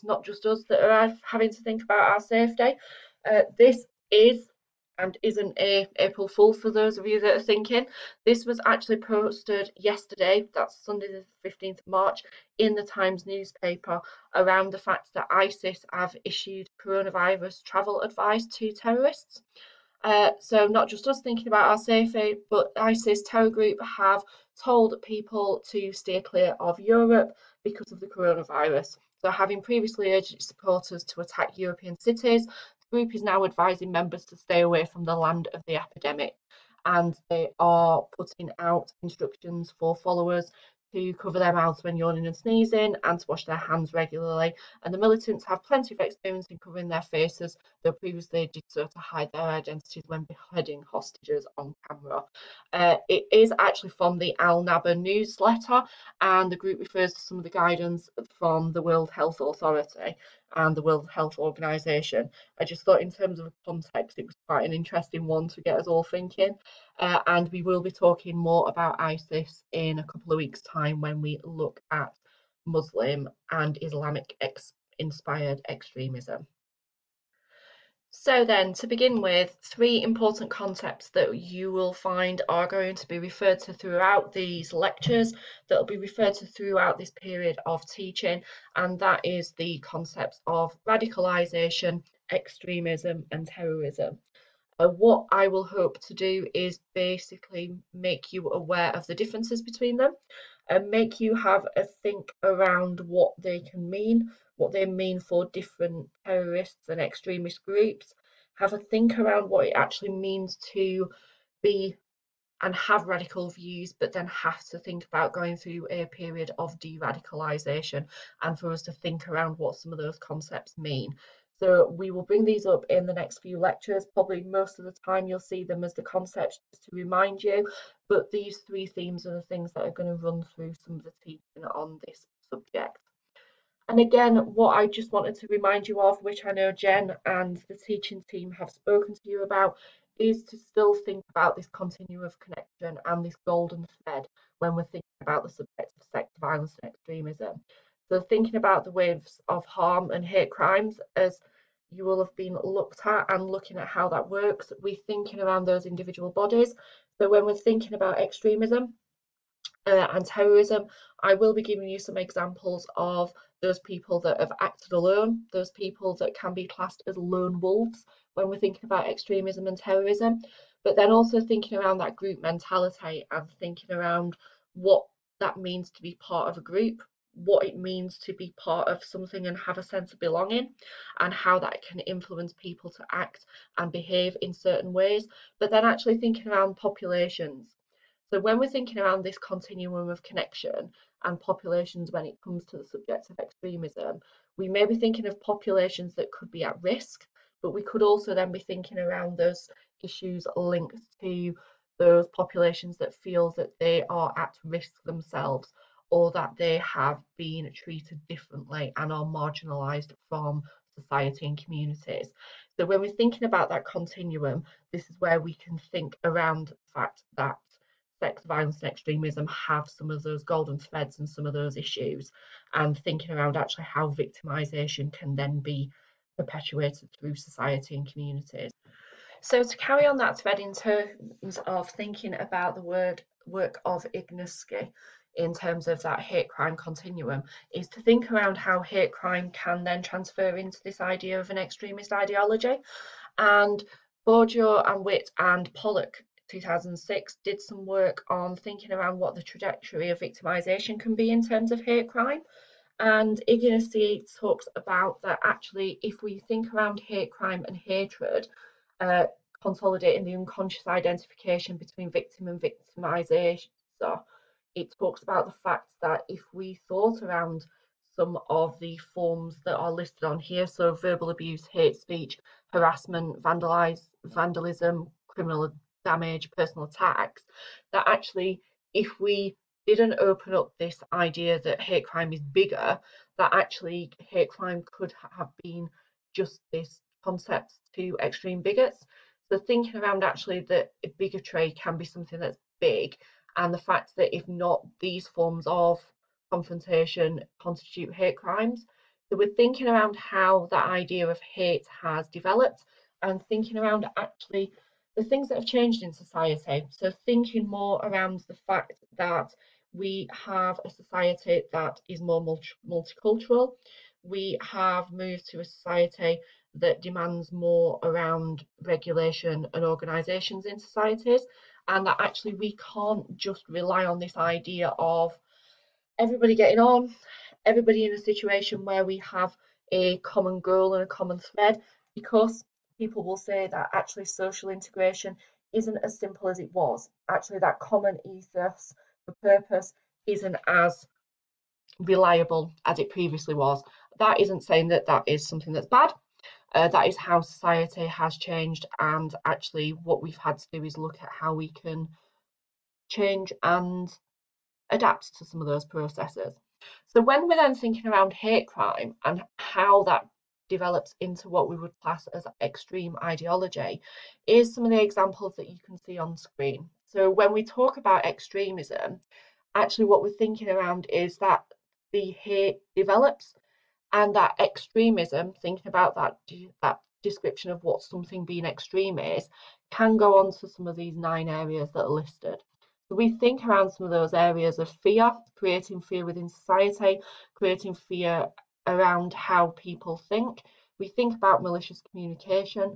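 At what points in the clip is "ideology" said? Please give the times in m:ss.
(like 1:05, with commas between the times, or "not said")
4:02, 6:03.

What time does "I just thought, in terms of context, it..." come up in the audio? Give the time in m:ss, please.
1:02.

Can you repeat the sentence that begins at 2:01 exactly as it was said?
So we will bring these up in the next few lectures.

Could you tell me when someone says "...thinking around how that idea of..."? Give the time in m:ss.
4:59.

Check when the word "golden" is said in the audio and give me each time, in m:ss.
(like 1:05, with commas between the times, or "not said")
2:23, 3:40.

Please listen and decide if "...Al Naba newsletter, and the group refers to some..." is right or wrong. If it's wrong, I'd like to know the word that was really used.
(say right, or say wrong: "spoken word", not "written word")
right.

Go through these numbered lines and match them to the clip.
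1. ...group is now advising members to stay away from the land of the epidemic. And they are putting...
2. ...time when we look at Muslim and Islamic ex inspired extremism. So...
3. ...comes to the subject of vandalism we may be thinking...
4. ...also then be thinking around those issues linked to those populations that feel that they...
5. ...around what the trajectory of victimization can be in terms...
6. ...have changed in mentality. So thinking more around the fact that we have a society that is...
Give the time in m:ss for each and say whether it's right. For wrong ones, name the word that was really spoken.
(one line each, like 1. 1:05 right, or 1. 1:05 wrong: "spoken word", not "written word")
1. 0:32 right
2. 1:10 right
3. 3:12 wrong: "extremism", not "vandalism"
4. 3:18 right
5. 4:08 right
6. 5:05 wrong: "society", not "mentality".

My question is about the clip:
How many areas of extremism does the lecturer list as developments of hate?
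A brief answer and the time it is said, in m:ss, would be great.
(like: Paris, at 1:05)
9, at 6:21.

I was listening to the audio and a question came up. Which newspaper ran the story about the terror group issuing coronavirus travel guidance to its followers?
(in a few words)
The Times.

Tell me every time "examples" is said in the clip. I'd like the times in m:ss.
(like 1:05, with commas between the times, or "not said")
2:42, 6:05.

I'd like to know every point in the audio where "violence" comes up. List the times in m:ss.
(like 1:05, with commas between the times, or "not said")
2:26, 3:38.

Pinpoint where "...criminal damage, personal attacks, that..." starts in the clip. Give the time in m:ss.
4:35.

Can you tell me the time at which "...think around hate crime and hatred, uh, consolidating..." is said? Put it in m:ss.
4:16.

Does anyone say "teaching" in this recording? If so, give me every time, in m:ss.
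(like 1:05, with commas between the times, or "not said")
1:27, 2:11, 2:17.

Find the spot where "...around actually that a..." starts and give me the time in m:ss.
4:50.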